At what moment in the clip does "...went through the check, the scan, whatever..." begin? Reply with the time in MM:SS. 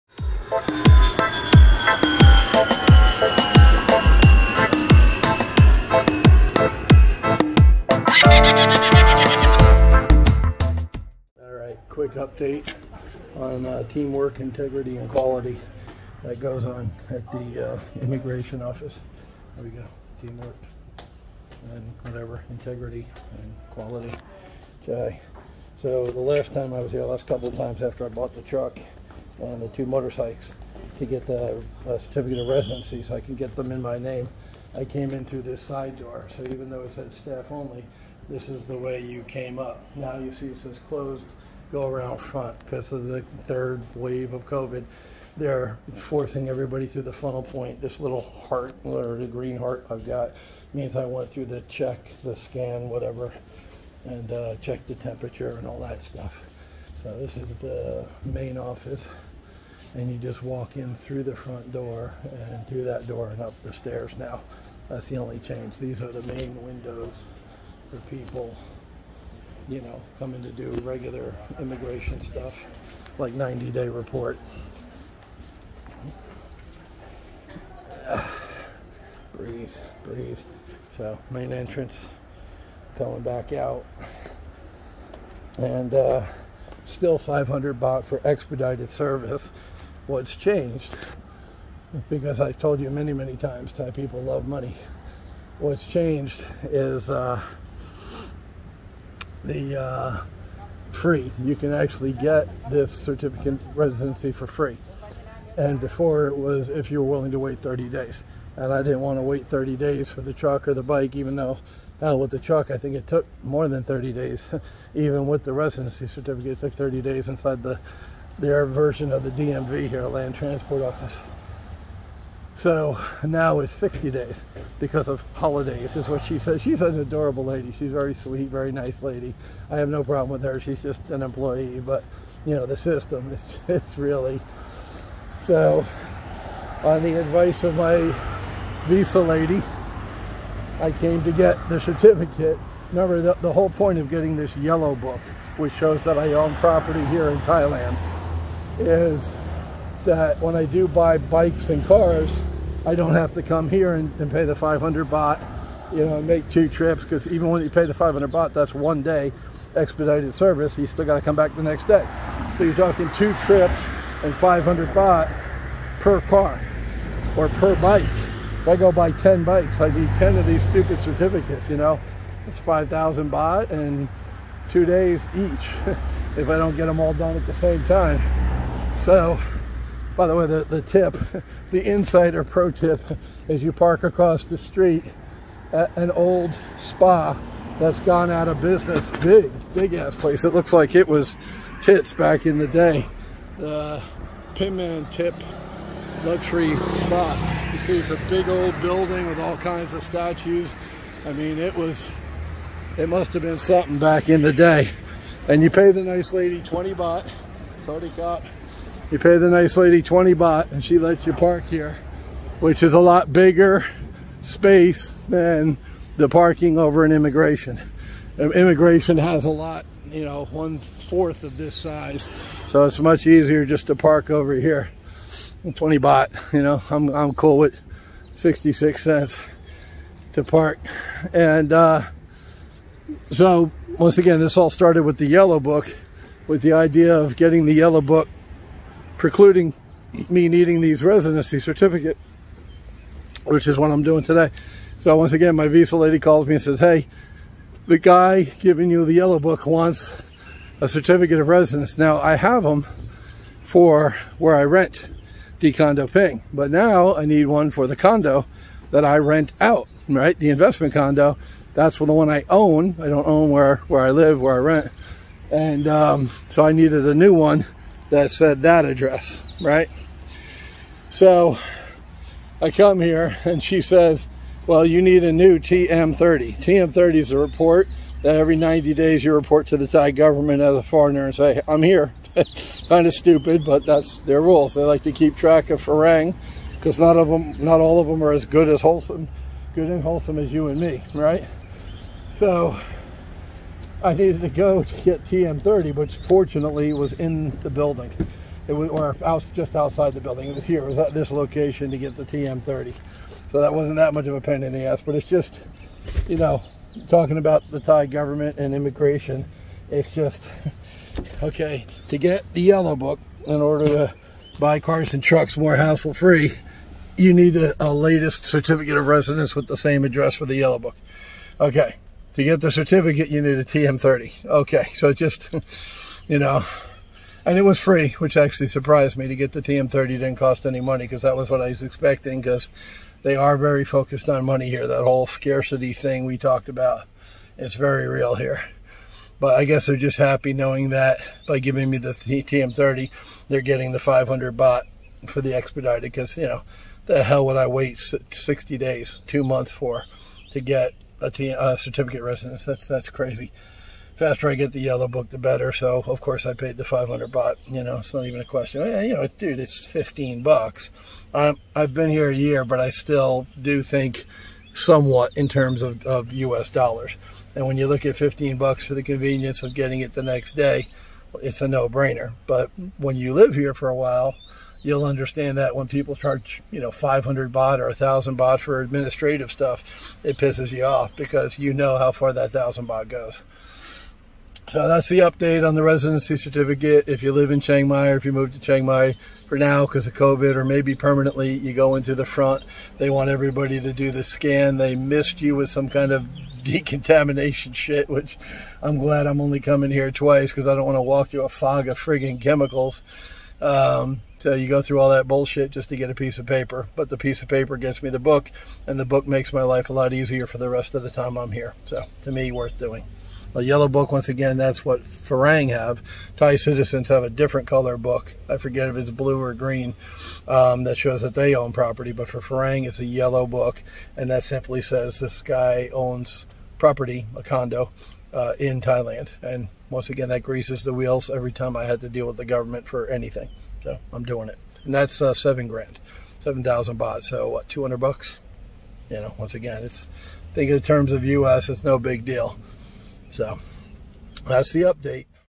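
00:51.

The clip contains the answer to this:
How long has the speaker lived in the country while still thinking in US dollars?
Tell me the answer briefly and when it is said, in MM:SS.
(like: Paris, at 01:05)
a year, at 06:02.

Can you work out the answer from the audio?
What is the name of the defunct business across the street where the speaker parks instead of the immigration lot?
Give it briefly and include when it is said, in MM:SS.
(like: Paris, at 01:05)
Pinman Tip Luxury Spa, at 03:14.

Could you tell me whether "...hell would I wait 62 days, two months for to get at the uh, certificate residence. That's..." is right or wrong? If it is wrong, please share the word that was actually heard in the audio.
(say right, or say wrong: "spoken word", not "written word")
wrong: "60", not "62".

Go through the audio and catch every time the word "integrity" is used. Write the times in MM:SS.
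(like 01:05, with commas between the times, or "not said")
00:14, 00:22.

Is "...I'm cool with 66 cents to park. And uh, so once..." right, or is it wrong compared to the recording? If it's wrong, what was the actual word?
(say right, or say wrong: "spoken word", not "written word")
right.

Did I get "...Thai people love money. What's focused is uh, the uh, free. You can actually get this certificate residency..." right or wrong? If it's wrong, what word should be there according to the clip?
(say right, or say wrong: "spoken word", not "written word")
wrong: "changed", not "focused".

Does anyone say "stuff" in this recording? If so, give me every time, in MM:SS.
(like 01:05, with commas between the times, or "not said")
00:56, 01:12, 06:19.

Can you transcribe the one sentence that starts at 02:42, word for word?
So you're talking two trips and 500 baht per car or per bike.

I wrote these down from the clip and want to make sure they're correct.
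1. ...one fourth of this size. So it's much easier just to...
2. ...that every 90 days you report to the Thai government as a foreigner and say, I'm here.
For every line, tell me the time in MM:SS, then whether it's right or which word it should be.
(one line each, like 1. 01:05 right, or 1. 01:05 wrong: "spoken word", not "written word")
1. 03:40 right
2. 04:38 right.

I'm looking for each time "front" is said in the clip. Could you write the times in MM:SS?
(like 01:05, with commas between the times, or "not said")
00:42, 01:01, 06:32.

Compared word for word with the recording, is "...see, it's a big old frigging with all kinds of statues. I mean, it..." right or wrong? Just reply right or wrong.
wrong.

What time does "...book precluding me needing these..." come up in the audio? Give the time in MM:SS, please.
03:57.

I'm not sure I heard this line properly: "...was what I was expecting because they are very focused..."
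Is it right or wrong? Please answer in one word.
right.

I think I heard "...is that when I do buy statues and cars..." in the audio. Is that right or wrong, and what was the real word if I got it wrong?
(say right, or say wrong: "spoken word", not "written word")
wrong: "bikes", not "statues".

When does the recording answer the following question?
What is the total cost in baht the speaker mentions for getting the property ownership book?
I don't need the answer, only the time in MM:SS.
07:16.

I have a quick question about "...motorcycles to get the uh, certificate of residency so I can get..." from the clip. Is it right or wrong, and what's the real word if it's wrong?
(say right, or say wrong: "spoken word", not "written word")
right.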